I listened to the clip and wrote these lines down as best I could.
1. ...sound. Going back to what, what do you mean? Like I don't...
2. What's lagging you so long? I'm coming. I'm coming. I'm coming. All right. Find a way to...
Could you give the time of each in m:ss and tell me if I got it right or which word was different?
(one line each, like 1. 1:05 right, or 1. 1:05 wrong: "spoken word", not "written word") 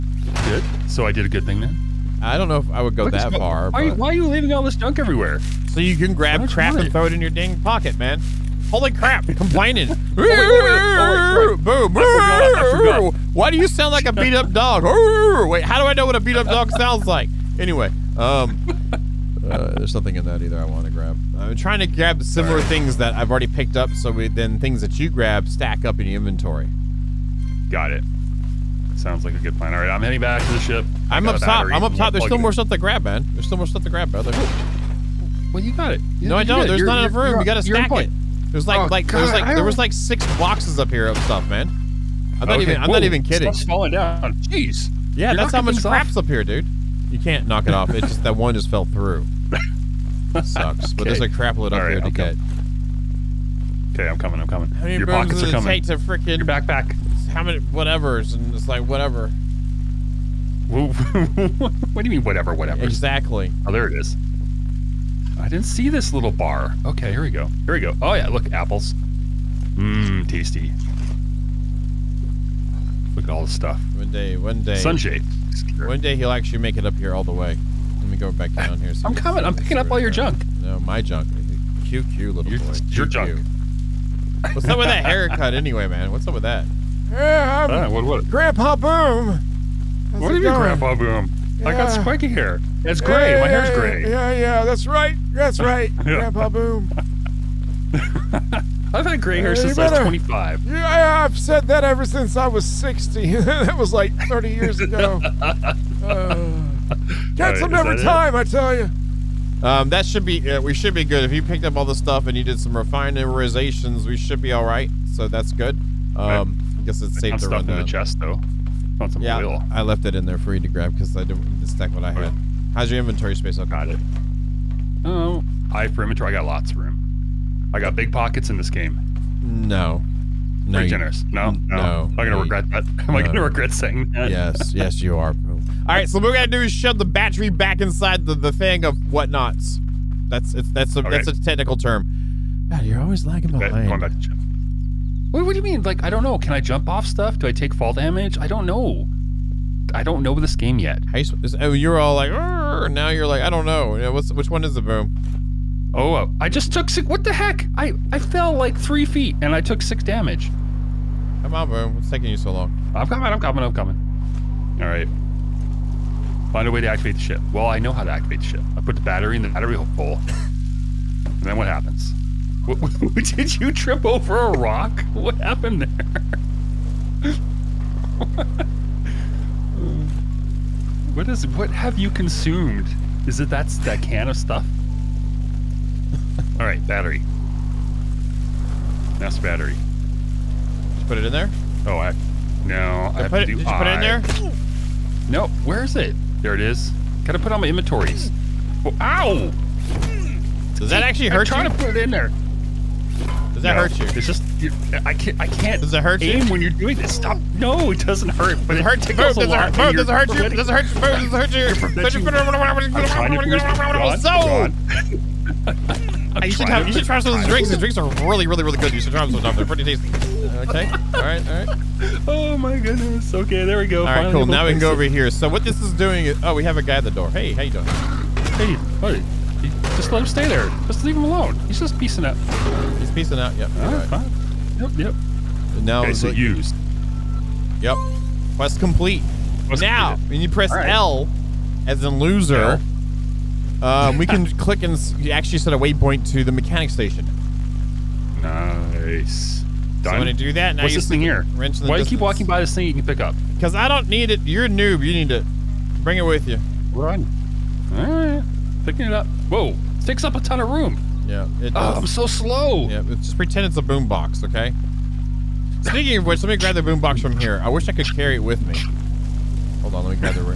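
1. 2:23 wrong: "behind", not "sound"
2. 2:41 wrong: "taking", not "lagging".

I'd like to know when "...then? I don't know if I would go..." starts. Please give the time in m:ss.
0:01.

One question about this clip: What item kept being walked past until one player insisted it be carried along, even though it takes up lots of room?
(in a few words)
Wrench.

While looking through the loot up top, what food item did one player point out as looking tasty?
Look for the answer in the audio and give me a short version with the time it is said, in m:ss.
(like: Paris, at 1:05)
apples, at 1:08.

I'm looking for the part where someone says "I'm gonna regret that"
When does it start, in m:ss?
2:12.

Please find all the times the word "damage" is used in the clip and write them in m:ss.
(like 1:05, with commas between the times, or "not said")
2:27, 2:40.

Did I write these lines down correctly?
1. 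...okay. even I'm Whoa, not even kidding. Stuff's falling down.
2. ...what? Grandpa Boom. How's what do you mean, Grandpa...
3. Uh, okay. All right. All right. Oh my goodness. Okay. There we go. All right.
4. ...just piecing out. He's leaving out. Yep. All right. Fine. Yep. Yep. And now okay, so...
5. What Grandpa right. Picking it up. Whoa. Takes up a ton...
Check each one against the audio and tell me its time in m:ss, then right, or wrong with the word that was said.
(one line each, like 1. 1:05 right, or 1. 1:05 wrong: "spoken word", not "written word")
1. 0:42 right
2. 1:28 right
3. 3:40 right
4. 3:51 wrong: "piecing", not "leaving"
5. 4:16 wrong: "All", not "Grandpa".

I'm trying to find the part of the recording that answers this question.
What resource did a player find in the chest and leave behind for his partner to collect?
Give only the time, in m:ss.
1:59.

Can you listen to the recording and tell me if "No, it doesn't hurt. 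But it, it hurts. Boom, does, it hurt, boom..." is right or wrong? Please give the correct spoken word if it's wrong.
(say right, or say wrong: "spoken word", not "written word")
right.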